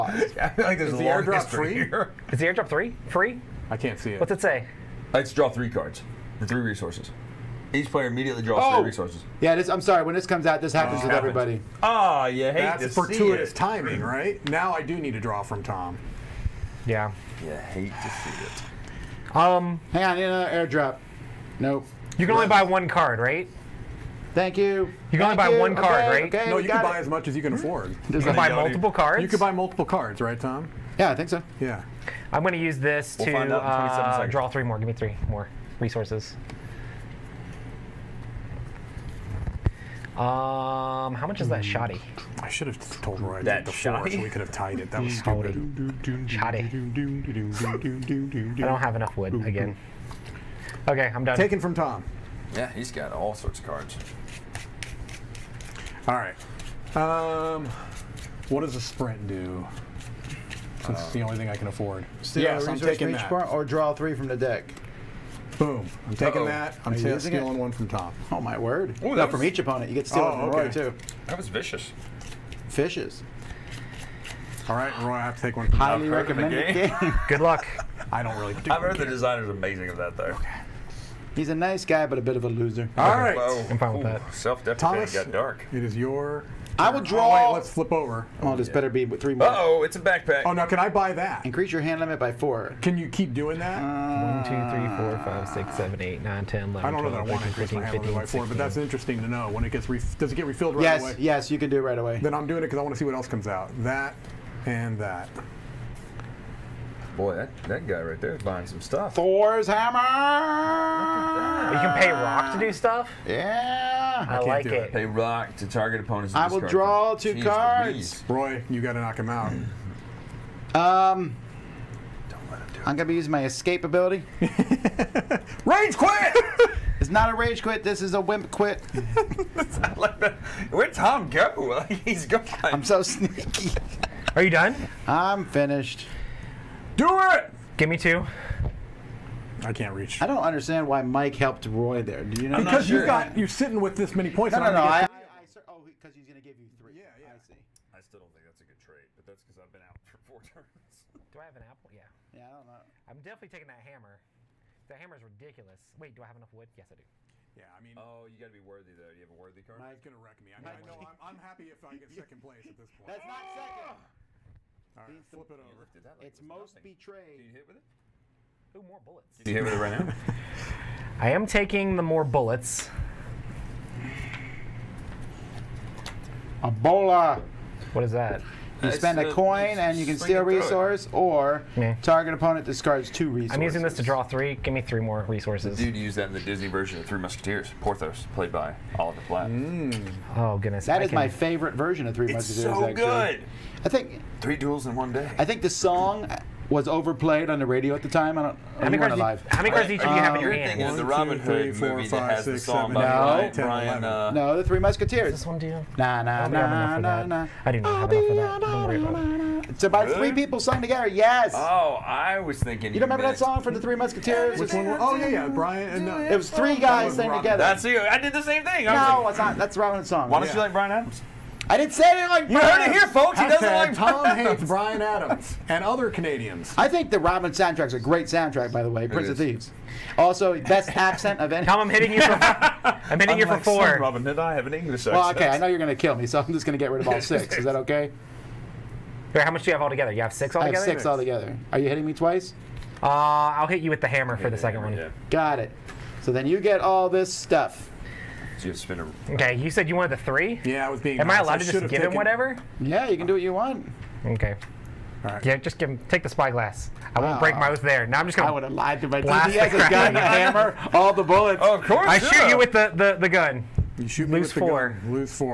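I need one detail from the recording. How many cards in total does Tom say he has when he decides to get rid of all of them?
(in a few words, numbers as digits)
6.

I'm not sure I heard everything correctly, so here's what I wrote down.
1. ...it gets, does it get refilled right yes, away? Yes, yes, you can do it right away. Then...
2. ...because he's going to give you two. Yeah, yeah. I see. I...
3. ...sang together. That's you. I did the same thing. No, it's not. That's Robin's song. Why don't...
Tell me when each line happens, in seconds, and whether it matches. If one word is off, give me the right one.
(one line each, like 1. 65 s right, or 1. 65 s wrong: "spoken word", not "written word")
1. 99 s right
2. 145 s wrong: "three", not "two"
3. 217 s right.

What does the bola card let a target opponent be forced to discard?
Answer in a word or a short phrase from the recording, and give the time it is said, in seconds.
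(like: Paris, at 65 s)
Two resources, at 183 s.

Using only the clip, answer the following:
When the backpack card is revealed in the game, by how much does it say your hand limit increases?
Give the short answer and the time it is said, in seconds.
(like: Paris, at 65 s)
4, at 91 s.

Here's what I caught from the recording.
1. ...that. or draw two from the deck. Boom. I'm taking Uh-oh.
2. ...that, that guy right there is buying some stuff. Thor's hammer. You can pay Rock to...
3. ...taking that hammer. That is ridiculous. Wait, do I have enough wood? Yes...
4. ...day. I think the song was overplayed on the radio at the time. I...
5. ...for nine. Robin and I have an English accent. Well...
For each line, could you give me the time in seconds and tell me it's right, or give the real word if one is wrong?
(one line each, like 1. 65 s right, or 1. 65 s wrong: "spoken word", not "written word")
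1. 63 s wrong: "three", not "two"
2. 107 s right
3. 153 s right
4. 195 s right
5. 233 s wrong: "four", not "nine".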